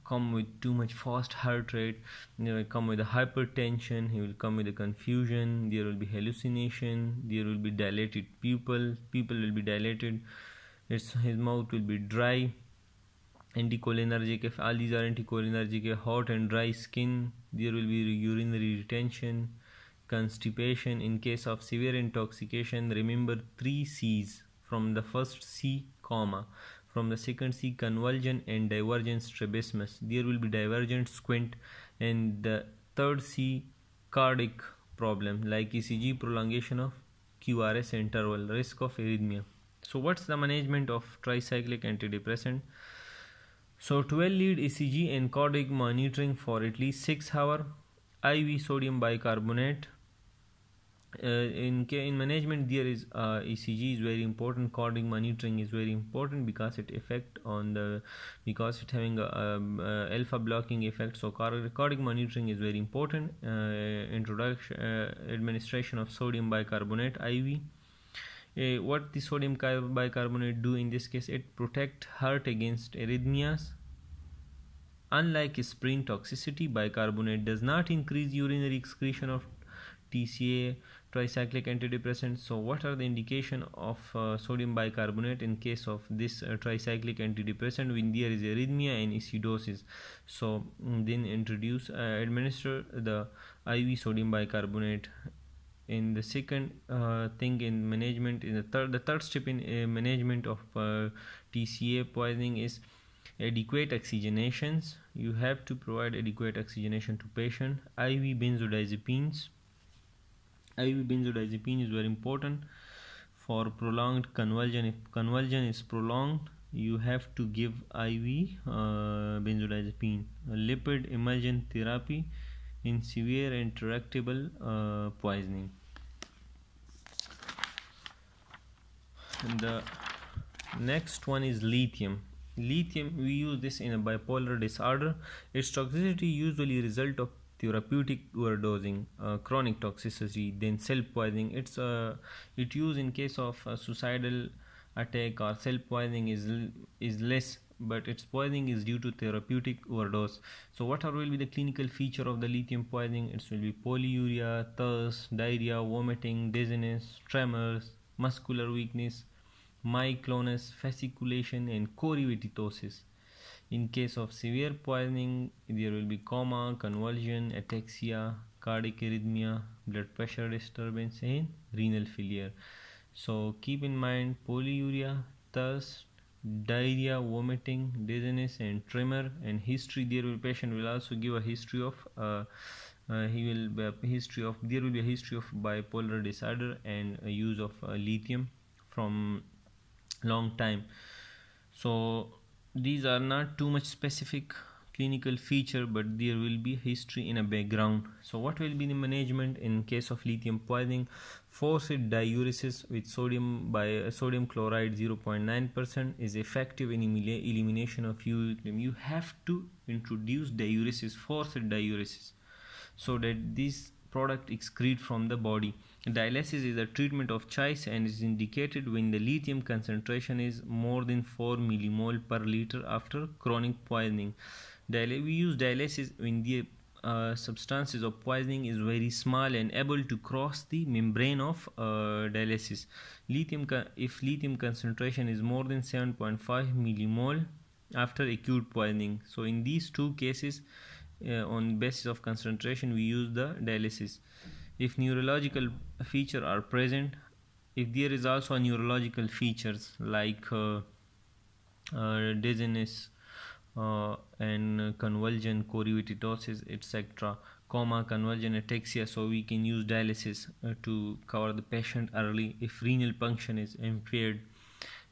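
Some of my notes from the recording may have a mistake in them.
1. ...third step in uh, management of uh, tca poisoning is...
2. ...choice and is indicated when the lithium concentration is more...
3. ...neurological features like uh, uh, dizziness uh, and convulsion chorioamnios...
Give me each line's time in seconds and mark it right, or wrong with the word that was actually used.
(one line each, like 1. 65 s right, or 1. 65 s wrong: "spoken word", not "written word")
1. 99 s right
2. 217 s right
3. 248 s right.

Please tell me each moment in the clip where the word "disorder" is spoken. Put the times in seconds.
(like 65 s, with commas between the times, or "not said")
134 s, 186 s.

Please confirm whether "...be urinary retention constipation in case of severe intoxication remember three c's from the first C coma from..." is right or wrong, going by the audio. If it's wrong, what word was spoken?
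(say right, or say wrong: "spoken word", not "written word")
right.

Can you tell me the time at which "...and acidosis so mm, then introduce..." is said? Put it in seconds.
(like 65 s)
89 s.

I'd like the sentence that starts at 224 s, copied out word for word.
we use dialysis when the uh, substances of poisoning is very small and able to cross the membrane of uh, dialysis.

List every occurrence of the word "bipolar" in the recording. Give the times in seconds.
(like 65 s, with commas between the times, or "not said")
133 s, 185 s.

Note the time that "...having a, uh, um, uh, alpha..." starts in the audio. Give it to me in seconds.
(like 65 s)
58 s.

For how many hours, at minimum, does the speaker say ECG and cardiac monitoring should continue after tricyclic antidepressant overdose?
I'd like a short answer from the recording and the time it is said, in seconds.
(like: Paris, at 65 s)
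6 hours, at 47 s.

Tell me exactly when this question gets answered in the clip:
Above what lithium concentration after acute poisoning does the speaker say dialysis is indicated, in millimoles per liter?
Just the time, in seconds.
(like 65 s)
235 s.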